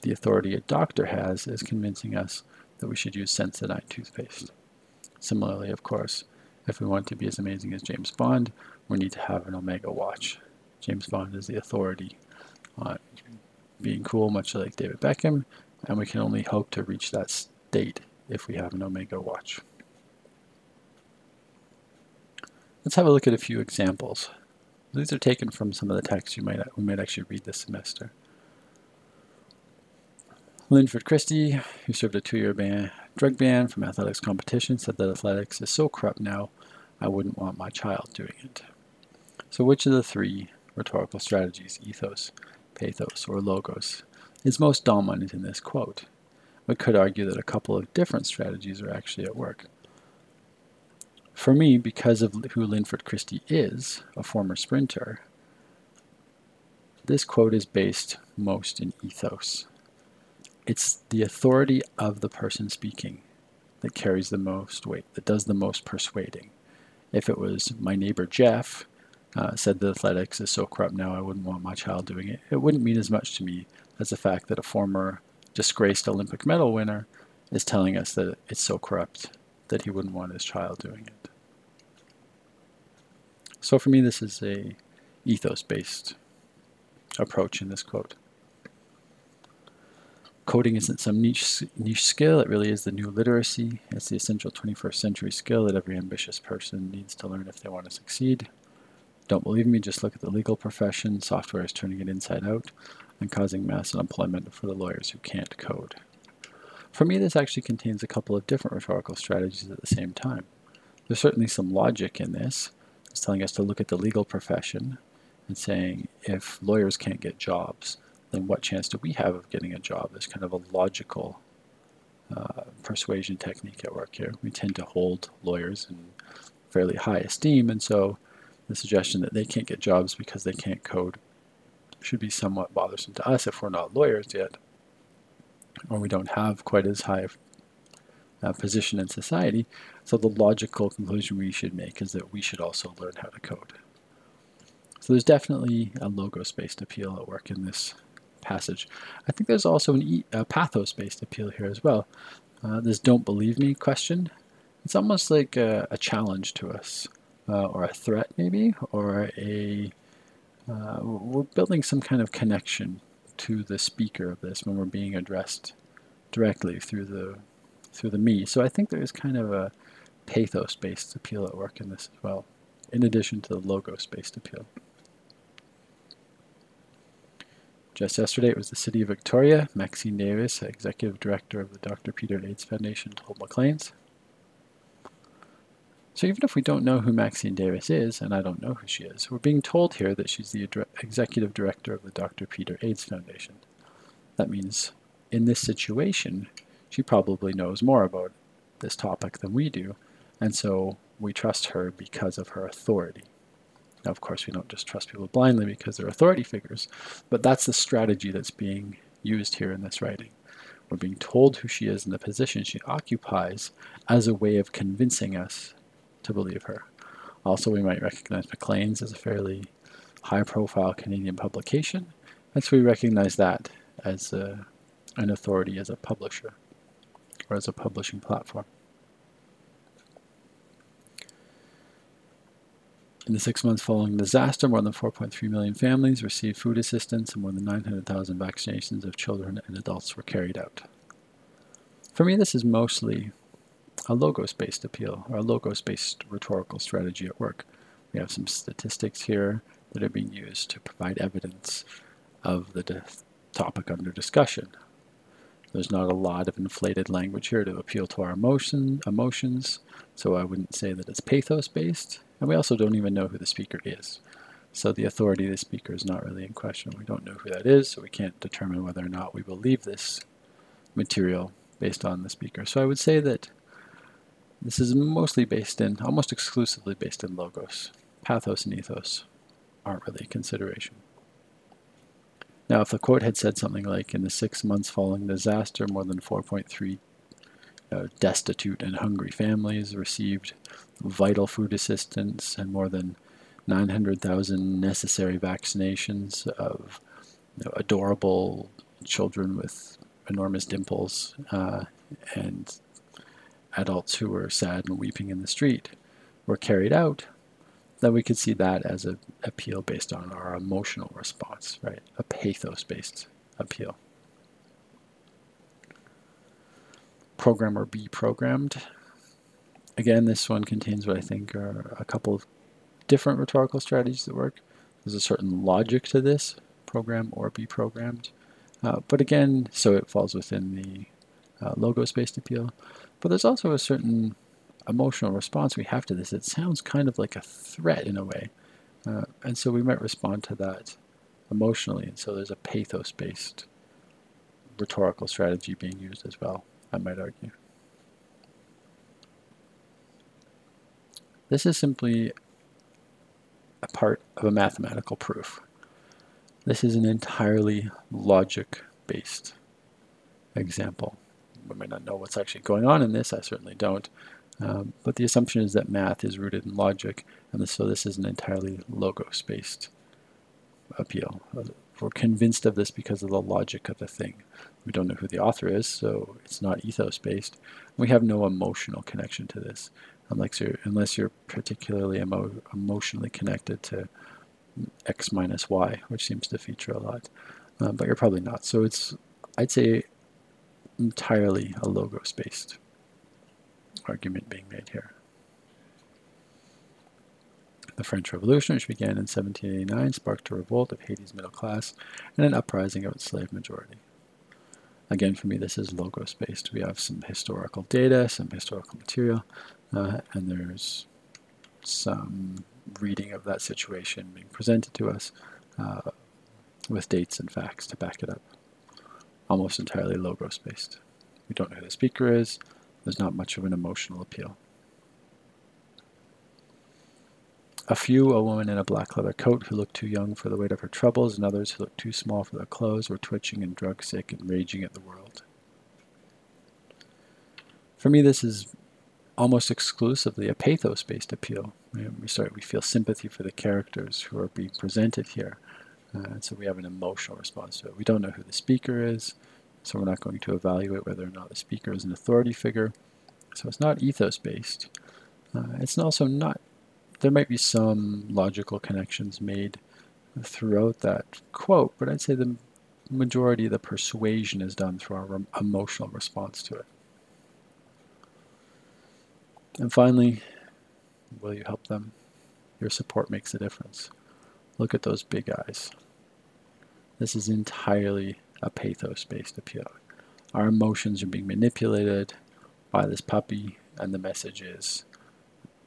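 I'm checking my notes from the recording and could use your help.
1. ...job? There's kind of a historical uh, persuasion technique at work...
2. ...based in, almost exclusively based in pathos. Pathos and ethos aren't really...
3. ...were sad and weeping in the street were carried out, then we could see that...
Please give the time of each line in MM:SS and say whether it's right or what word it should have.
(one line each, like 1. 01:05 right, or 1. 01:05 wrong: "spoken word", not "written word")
1. 01:59 wrong: "logical", not "historical"
2. 04:35 wrong: "logos", not "pathos"
3. 05:04 right.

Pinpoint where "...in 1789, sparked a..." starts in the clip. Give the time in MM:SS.
06:39.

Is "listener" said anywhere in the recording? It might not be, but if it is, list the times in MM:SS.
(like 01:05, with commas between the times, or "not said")
not said.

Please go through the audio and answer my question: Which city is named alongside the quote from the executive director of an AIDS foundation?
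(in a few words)
Victoria.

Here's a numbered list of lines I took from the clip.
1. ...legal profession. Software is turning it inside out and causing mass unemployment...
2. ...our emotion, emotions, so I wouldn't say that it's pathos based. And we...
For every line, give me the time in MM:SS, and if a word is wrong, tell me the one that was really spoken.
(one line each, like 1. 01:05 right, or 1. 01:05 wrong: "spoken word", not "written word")
1. 01:40 right
2. 04:18 right.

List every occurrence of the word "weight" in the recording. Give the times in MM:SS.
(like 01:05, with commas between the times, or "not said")
01:04, 07:10.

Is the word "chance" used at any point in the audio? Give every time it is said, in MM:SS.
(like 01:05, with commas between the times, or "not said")
01:58.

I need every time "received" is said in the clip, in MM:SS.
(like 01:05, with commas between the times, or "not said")
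03:56, 04:49.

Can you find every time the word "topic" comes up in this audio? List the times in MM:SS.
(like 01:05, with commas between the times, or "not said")
03:18, 04:13.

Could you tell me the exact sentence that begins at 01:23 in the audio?
So for me, this is a ethos-based approach in this quote.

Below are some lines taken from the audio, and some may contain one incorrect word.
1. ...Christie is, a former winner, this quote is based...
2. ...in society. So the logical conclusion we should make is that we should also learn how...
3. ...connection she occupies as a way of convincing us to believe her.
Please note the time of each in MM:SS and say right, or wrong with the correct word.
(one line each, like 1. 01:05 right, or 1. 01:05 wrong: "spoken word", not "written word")
1. 00:53 wrong: "sprinter", not "winner"
2. 02:19 right
3. 03:32 wrong: "position", not "connection".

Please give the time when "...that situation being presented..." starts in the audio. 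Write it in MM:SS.
06:53.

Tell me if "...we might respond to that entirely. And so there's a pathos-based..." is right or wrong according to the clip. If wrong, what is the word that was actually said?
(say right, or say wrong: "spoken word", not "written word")
wrong: "emotionally", not "entirely".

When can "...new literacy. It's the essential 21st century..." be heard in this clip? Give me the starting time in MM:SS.
01:32.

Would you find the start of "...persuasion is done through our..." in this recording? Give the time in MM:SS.
07:43.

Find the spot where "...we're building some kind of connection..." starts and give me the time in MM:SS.
02:41.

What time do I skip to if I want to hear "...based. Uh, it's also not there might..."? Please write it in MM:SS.
07:34.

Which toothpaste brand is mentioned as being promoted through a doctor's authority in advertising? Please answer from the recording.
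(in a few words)
Sensodyne.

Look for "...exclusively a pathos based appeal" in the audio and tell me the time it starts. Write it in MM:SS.
07:19.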